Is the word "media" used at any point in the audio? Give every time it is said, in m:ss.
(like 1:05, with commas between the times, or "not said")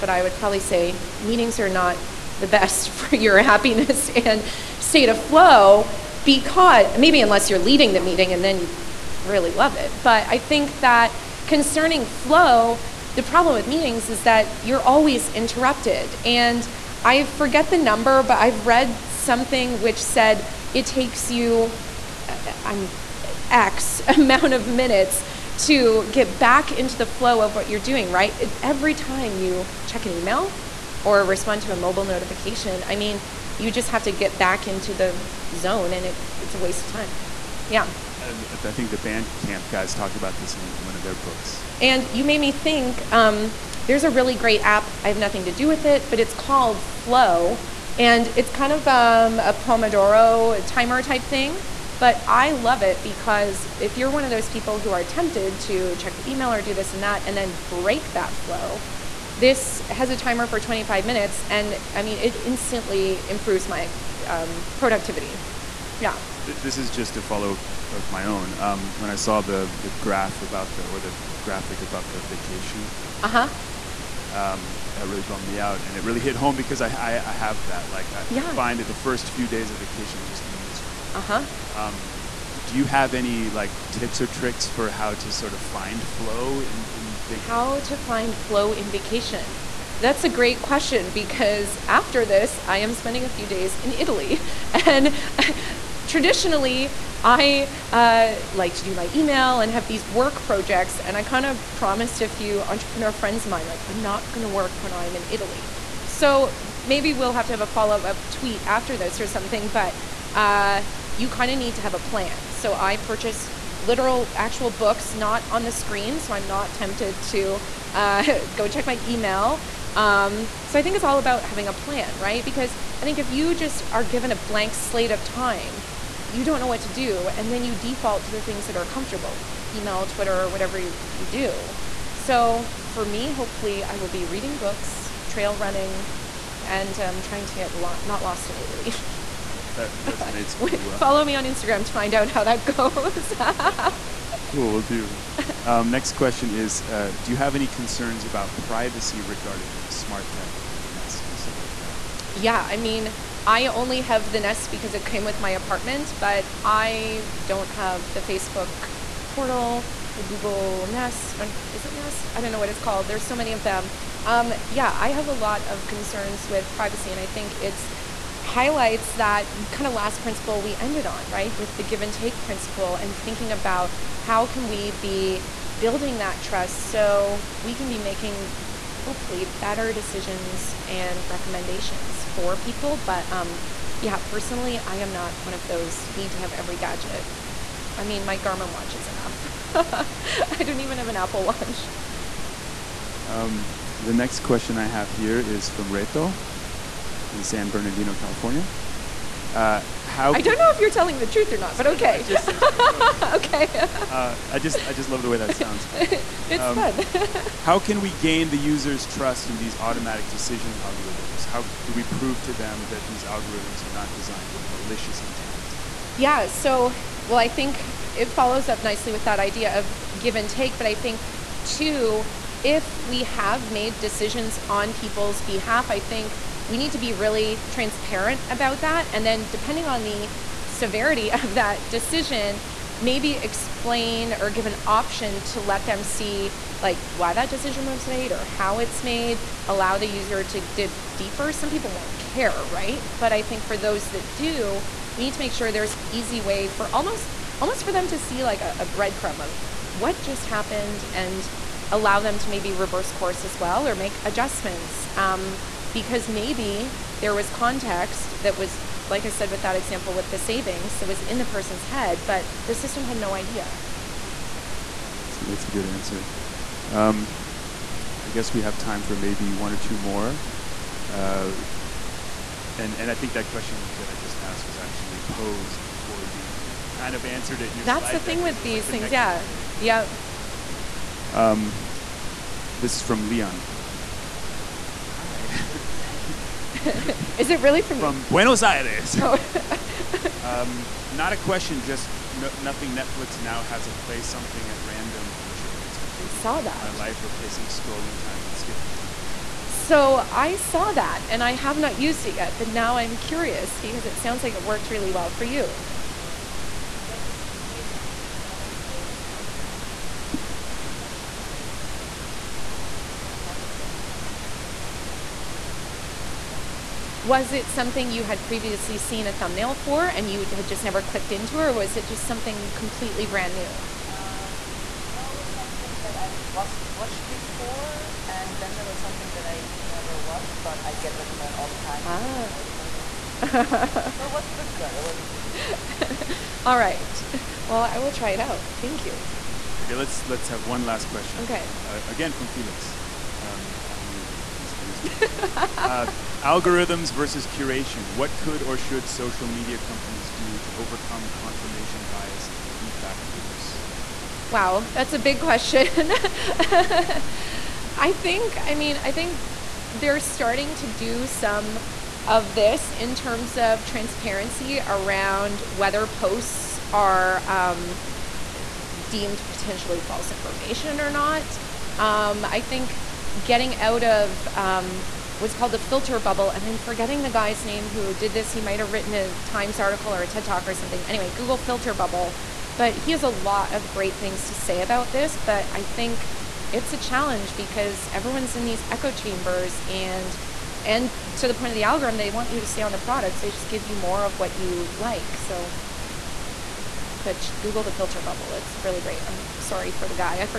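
5:49.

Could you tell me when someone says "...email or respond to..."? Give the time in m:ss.
0:30.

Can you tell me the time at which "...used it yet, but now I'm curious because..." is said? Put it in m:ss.
5:01.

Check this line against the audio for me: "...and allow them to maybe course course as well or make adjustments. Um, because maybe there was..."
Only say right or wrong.
wrong.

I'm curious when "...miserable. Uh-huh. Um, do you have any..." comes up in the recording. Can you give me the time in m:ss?
1:20.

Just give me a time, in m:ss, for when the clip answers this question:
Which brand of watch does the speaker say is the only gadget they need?
3:08.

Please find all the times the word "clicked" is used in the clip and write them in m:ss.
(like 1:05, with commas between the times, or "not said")
5:21.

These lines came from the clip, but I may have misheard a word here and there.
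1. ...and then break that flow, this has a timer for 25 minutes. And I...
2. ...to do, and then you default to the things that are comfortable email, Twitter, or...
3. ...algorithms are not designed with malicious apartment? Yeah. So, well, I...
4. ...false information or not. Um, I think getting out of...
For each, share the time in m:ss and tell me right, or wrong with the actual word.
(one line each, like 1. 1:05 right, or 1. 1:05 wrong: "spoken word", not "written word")
1. 0:57 right
2. 2:06 right
3. 3:33 wrong: "intent", not "apartment"
4. 6:09 right.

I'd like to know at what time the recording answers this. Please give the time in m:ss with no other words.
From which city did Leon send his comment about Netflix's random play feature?
4:48.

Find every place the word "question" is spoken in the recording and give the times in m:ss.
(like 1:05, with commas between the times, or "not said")
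1:30, 2:26, 3:14, 4:33, 4:51, 5:41, 5:55.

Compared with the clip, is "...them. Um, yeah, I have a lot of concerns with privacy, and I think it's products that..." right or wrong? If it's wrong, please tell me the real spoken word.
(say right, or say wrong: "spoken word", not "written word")
wrong: "highlights", not "products".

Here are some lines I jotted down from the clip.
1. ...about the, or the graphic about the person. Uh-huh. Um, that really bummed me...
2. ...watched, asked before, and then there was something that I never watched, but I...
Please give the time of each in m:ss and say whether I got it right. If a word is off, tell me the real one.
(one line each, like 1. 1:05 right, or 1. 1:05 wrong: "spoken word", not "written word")
1. 1:10 wrong: "vacation", not "person"
2. 5:26 wrong: "watched", not "asked".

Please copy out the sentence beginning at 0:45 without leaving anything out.
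I have nothing to do with it, but it's called Flow.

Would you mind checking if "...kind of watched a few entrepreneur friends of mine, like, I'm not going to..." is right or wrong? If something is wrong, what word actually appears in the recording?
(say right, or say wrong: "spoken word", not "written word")
wrong: "promised", not "watched".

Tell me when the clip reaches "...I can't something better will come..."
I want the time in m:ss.
5:14.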